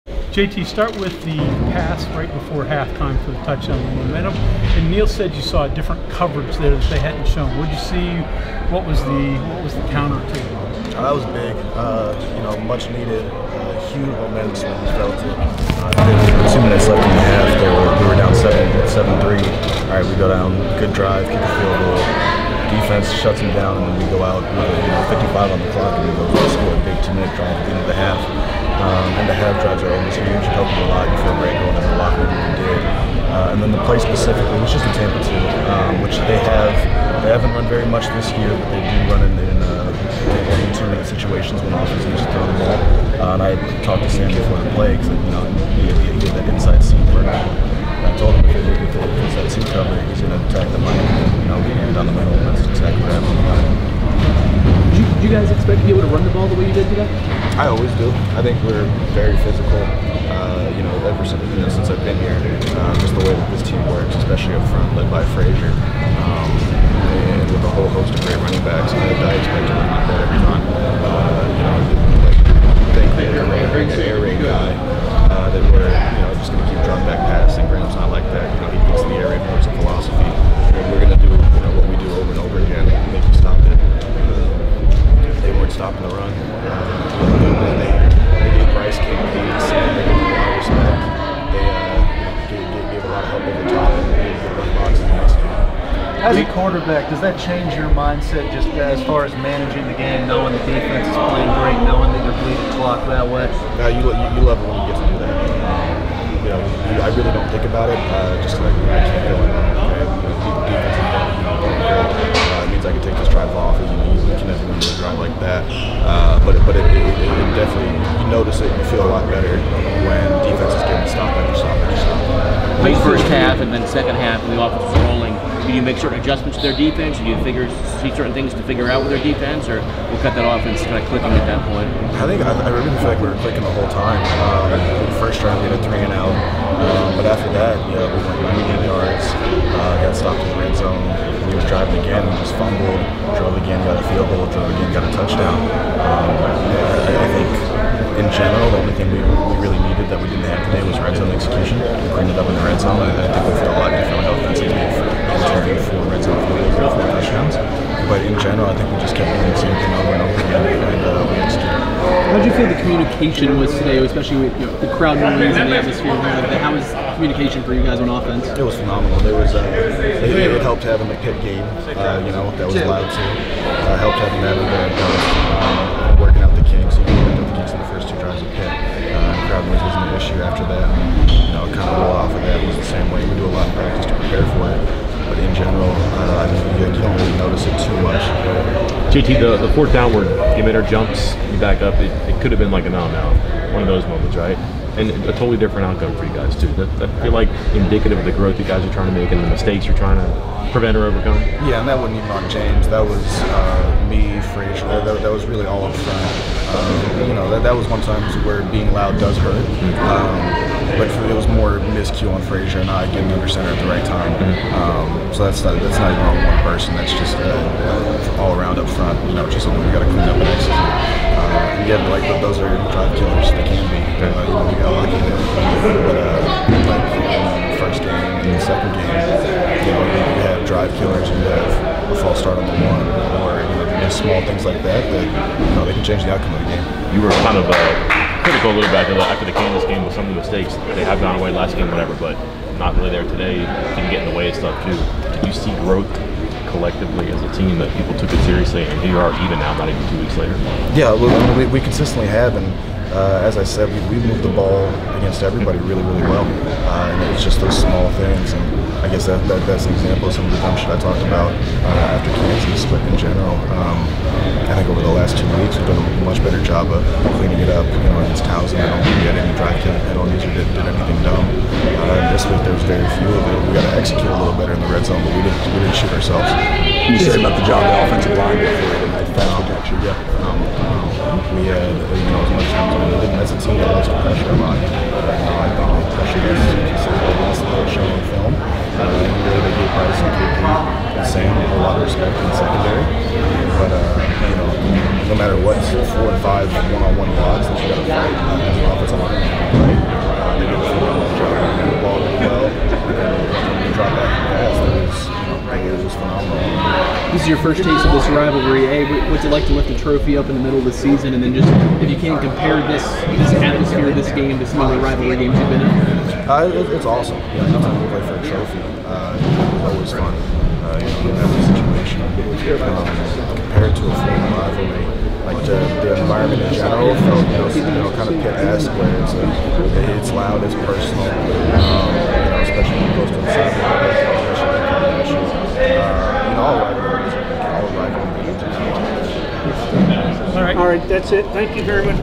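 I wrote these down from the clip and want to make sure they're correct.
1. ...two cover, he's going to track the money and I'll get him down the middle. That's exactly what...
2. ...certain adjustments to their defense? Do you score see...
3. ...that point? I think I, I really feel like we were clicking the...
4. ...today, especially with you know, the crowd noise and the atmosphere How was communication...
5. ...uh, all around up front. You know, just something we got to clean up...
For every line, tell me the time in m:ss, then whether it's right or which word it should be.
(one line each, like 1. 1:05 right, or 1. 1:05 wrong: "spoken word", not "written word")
1. 0:49 right
2. 2:06 wrong: "figure", not "score"
3. 2:11 right
4. 2:43 right
5. 3:37 right.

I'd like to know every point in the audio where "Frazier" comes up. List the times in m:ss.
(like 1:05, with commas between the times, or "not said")
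1:05, 3:24, 3:32.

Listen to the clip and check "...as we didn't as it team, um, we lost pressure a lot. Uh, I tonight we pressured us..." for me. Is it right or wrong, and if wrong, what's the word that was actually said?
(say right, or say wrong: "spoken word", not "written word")
wrong: "thought", not "tonight".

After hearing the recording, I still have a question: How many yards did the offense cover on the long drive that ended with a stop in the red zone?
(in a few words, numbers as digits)
98.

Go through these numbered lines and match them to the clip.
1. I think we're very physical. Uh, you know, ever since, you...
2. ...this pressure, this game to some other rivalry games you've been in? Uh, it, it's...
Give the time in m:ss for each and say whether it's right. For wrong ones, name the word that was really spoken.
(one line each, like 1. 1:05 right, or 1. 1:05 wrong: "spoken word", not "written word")
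1. 0:58 right
2. 5:13 wrong: "atmosphere", not "pressure".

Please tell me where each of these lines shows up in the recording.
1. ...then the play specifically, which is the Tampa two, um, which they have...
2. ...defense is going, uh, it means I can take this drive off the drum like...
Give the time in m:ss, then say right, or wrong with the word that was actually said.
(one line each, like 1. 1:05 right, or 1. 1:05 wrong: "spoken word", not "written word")
1. 0:33 right
2. 1:50 right.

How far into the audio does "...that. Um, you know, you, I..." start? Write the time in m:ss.
1:45.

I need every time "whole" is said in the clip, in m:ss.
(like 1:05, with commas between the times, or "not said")
1:07, 2:13.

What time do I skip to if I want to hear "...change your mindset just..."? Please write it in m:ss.
1:37.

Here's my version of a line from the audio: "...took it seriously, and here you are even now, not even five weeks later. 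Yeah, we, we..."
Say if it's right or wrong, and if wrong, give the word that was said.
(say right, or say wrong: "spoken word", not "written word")
wrong: "two", not "five".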